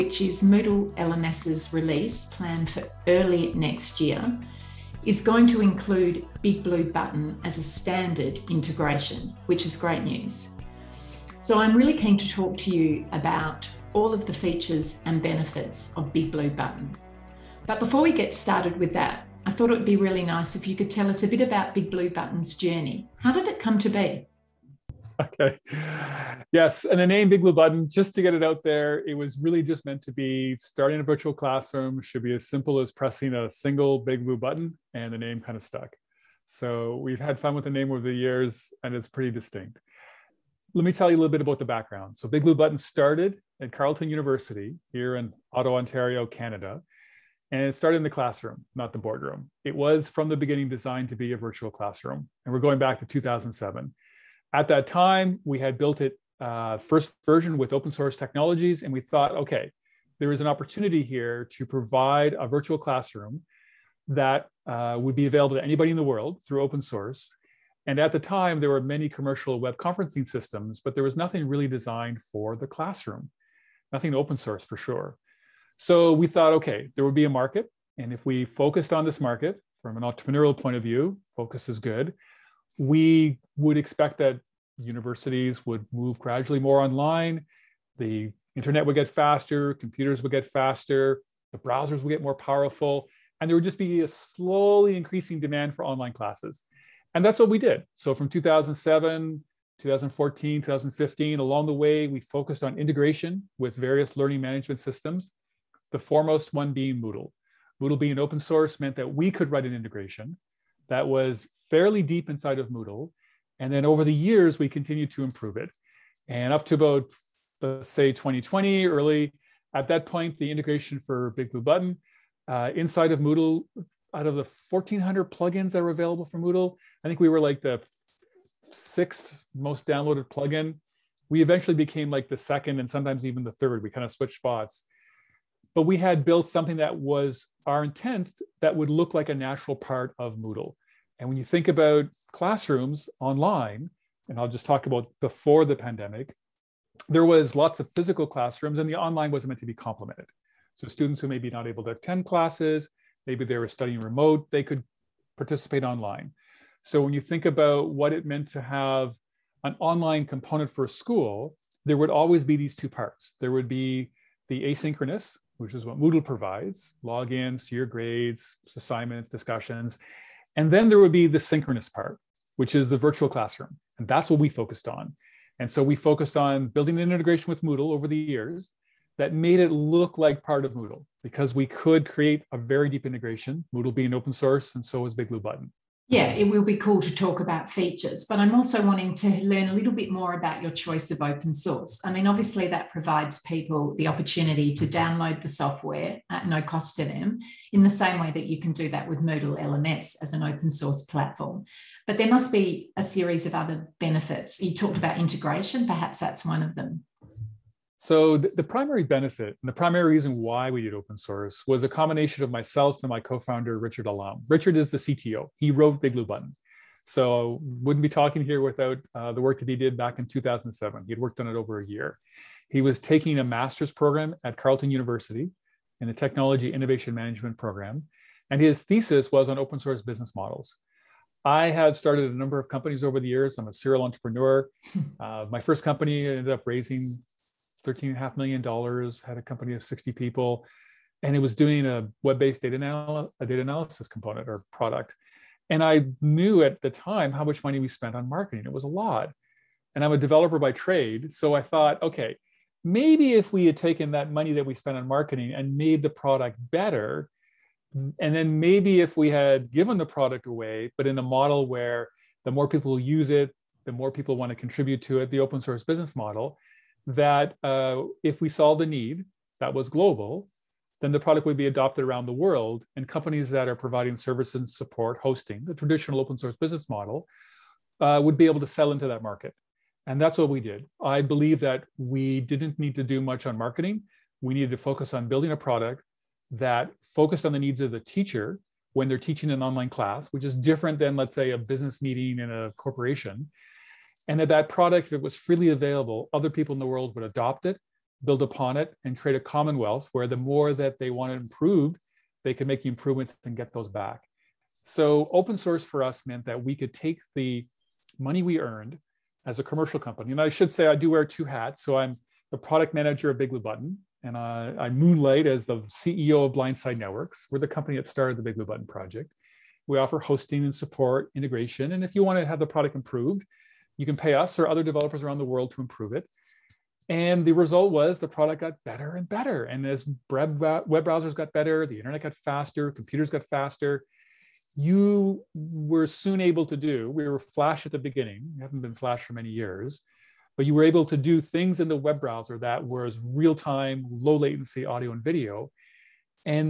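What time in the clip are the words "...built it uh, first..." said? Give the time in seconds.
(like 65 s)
55 s.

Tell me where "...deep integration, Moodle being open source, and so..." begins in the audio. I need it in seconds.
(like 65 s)
182 s.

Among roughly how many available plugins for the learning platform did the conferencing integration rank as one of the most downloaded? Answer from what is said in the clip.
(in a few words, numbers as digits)
1,400.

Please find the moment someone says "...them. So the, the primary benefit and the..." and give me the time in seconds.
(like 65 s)
206 s.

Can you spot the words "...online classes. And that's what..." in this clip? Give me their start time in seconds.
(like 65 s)
95 s.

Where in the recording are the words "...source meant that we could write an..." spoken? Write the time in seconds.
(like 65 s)
108 s.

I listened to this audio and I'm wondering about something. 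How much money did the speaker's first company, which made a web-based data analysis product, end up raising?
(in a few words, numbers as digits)
$13.5 million.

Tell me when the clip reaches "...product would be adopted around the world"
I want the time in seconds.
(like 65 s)
271 s.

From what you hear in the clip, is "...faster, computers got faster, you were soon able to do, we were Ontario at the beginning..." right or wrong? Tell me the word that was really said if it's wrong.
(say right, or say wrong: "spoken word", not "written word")
wrong: "Flash", not "Ontario".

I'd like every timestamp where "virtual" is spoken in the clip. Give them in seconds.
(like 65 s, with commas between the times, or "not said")
31 s, 51 s, 62 s, 172 s.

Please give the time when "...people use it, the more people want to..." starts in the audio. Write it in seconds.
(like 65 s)
262 s.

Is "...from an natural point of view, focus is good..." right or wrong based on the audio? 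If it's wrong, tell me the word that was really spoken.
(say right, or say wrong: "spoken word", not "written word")
wrong: "entrepreneurial", not "natural".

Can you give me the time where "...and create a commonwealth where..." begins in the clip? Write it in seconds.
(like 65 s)
299 s.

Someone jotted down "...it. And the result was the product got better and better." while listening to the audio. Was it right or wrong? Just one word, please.
right.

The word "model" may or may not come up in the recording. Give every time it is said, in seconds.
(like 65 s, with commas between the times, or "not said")
230 s, 261 s, 266 s, 276 s.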